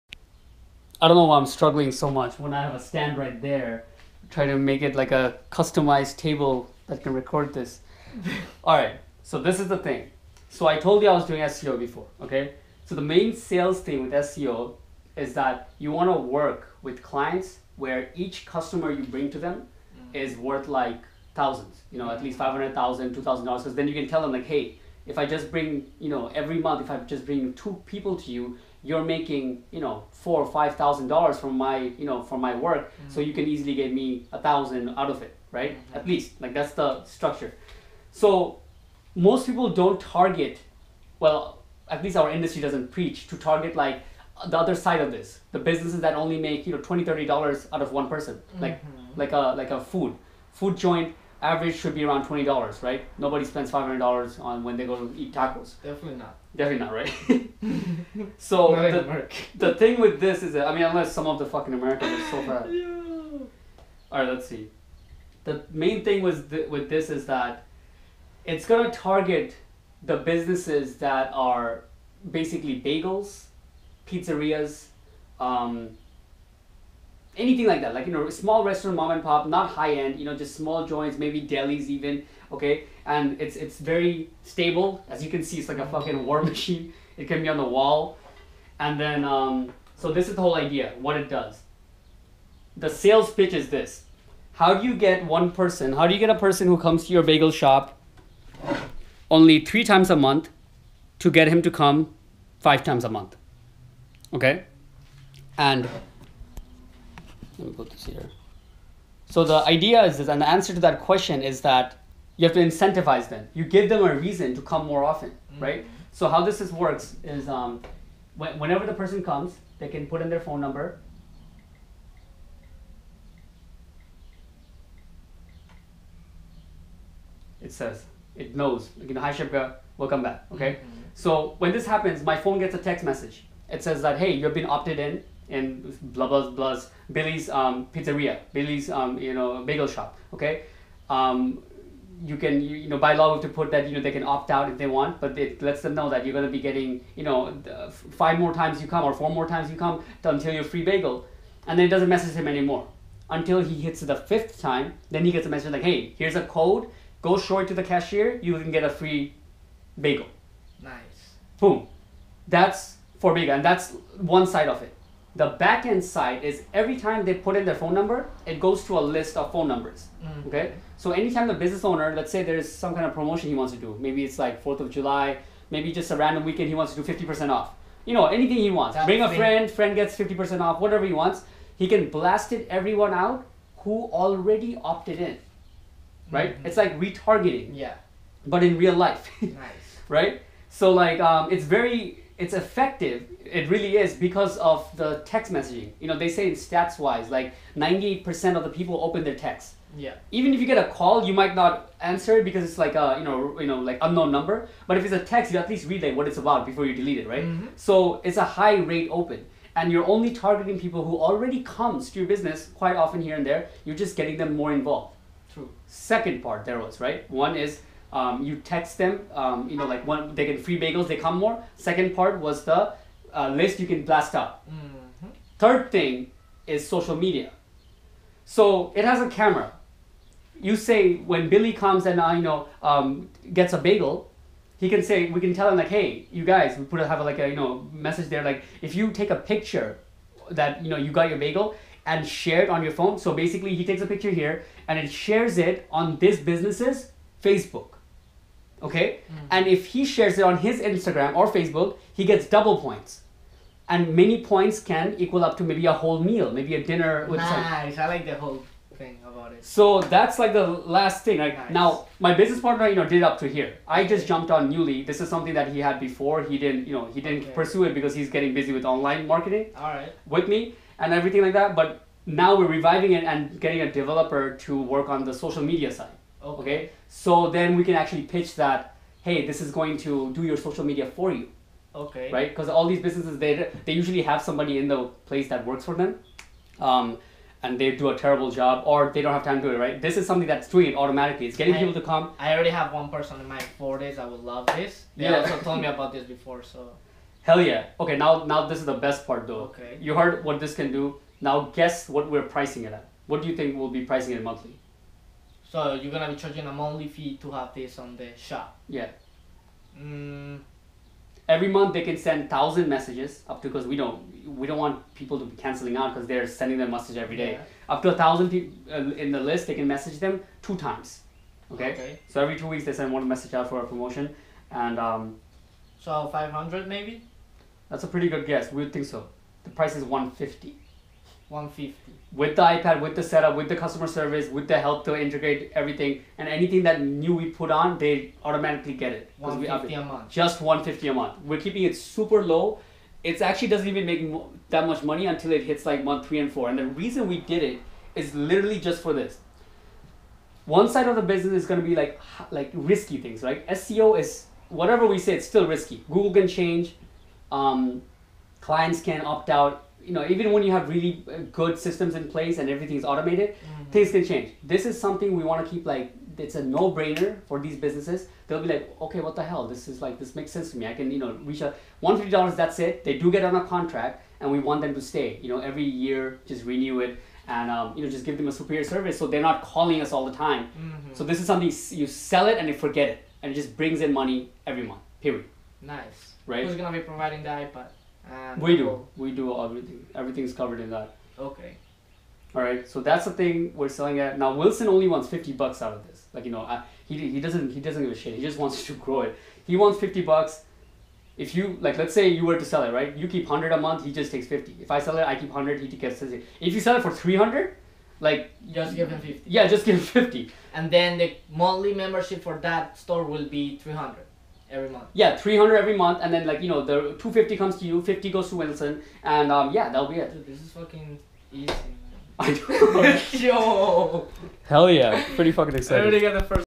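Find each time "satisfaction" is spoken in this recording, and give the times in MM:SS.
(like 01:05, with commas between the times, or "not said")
not said.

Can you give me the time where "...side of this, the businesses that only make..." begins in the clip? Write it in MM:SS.
00:44.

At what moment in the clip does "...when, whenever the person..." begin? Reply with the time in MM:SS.
01:58.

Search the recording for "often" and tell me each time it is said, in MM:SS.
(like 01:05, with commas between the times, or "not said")
01:55, 03:32.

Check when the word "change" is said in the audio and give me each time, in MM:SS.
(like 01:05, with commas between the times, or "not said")
05:56, 06:04.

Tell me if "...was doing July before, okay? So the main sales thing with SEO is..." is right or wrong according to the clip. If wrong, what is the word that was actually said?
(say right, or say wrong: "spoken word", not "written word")
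wrong: "SEO", not "July".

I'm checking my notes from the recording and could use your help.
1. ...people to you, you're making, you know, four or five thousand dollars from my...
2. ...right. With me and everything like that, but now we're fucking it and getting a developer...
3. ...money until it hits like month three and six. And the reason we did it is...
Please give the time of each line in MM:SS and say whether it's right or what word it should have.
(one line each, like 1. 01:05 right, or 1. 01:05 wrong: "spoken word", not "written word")
1. 00:27 right
2. 04:29 wrong: "reviving", not "fucking"
3. 05:45 wrong: "four", not "six".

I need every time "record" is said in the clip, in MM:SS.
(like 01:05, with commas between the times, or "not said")
00:07.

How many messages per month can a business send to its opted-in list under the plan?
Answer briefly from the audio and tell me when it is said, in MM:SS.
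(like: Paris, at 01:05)
1,000, at 05:12.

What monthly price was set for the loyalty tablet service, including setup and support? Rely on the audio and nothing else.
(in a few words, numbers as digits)
$150.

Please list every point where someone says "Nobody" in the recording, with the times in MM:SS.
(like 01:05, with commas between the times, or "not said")
00:53.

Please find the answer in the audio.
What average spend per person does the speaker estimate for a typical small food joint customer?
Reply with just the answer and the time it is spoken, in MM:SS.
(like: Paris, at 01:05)
$20, at 00:52.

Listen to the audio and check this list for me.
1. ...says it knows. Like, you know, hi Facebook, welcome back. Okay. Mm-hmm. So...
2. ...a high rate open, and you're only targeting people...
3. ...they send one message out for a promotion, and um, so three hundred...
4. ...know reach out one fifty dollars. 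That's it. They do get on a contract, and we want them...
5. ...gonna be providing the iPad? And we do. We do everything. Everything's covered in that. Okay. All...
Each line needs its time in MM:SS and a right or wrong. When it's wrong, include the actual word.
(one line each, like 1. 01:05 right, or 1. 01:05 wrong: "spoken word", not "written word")
1. 02:07 wrong: "Shibga", not "Facebook"
2. 03:28 right
3. 05:22 wrong: "five", not "three"
4. 06:11 right
5. 06:26 right.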